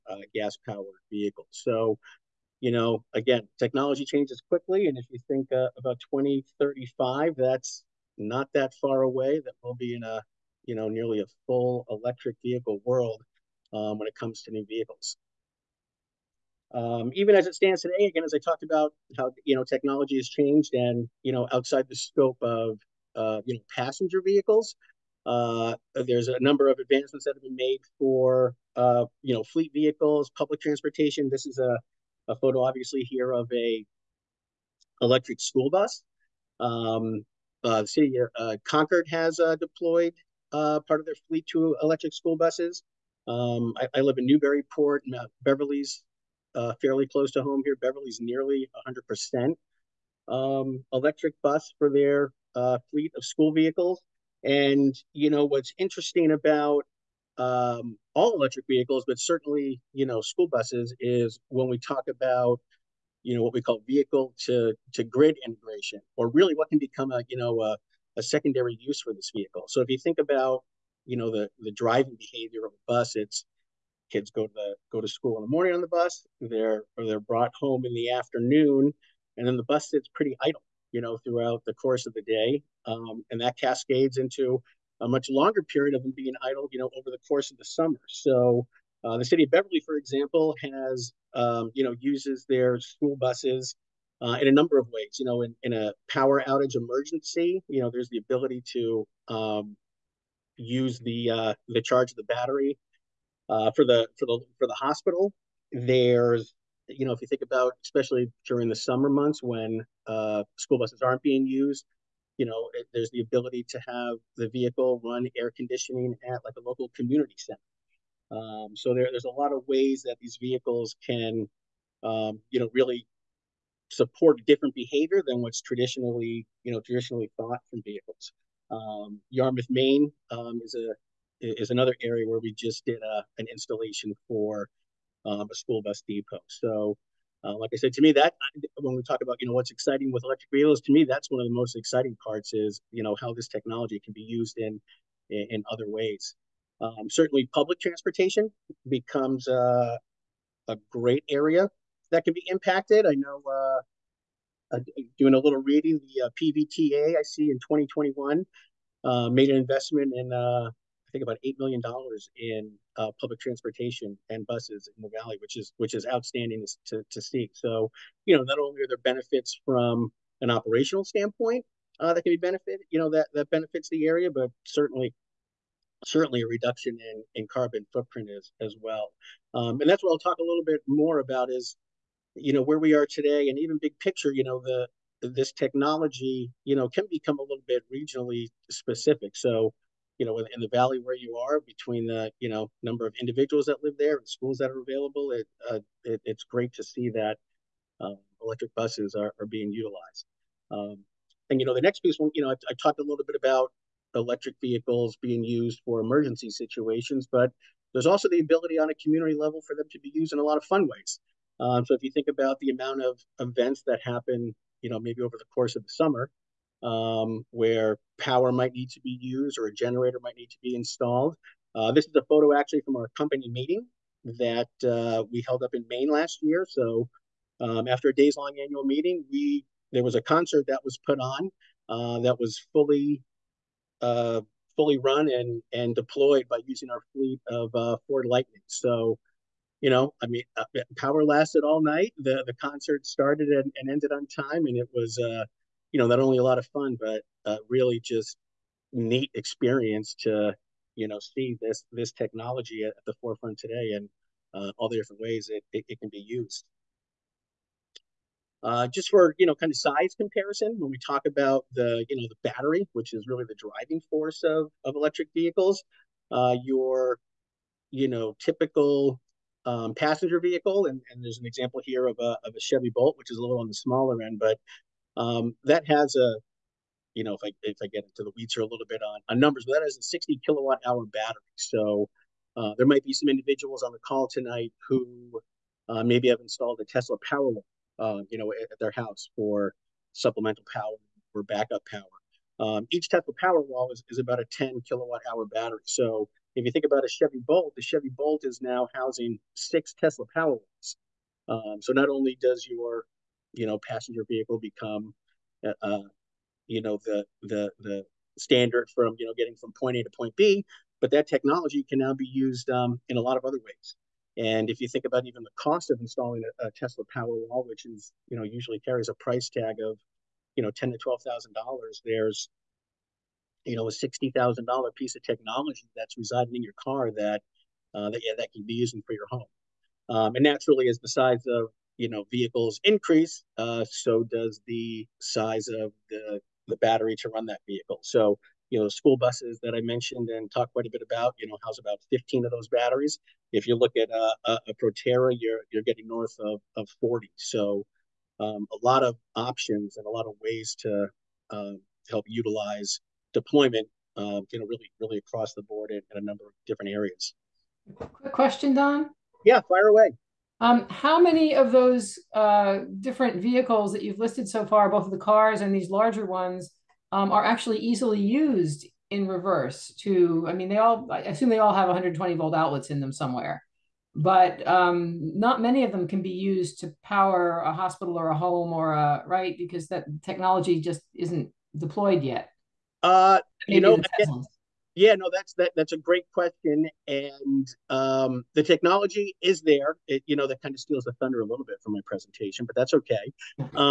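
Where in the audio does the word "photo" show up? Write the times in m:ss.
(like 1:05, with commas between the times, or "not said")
0:32, 3:42.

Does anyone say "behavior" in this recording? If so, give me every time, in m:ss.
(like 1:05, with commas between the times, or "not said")
1:12, 2:04.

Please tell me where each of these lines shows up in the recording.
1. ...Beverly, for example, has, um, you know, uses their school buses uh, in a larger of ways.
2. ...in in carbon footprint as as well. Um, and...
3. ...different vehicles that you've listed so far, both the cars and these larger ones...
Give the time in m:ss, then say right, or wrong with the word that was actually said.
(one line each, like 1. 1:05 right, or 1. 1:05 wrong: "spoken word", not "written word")
1. 1:29 wrong: "number", not "larger"
2. 2:57 right
3. 6:02 right.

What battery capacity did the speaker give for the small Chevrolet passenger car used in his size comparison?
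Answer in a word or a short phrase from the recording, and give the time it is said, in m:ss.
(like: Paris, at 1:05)
60 kWh, at 4:40.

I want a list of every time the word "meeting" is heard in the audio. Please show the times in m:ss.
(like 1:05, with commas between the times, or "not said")
3:43, 3:48.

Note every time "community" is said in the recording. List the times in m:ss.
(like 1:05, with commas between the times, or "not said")
1:56, 3:28.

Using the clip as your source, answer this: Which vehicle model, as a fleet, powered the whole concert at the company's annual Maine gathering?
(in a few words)
Ford Lightning.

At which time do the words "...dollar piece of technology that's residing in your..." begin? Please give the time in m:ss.
5:24.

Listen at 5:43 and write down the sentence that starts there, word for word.
If you look at uh, a, a Proterra, you're you're getting north of of 40.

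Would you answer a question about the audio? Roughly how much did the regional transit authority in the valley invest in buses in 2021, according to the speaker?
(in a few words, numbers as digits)
$8 million.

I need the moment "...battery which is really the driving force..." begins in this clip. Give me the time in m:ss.
4:22.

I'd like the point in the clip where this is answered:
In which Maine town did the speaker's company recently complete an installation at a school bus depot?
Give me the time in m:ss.
2:09.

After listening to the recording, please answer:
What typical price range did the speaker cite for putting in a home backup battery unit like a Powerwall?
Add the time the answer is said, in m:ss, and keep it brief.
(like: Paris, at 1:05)
$10,000 to $12,000, at 5:20.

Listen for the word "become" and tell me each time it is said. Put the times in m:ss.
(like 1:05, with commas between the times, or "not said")
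1:06, 2:28, 3:07, 5:04.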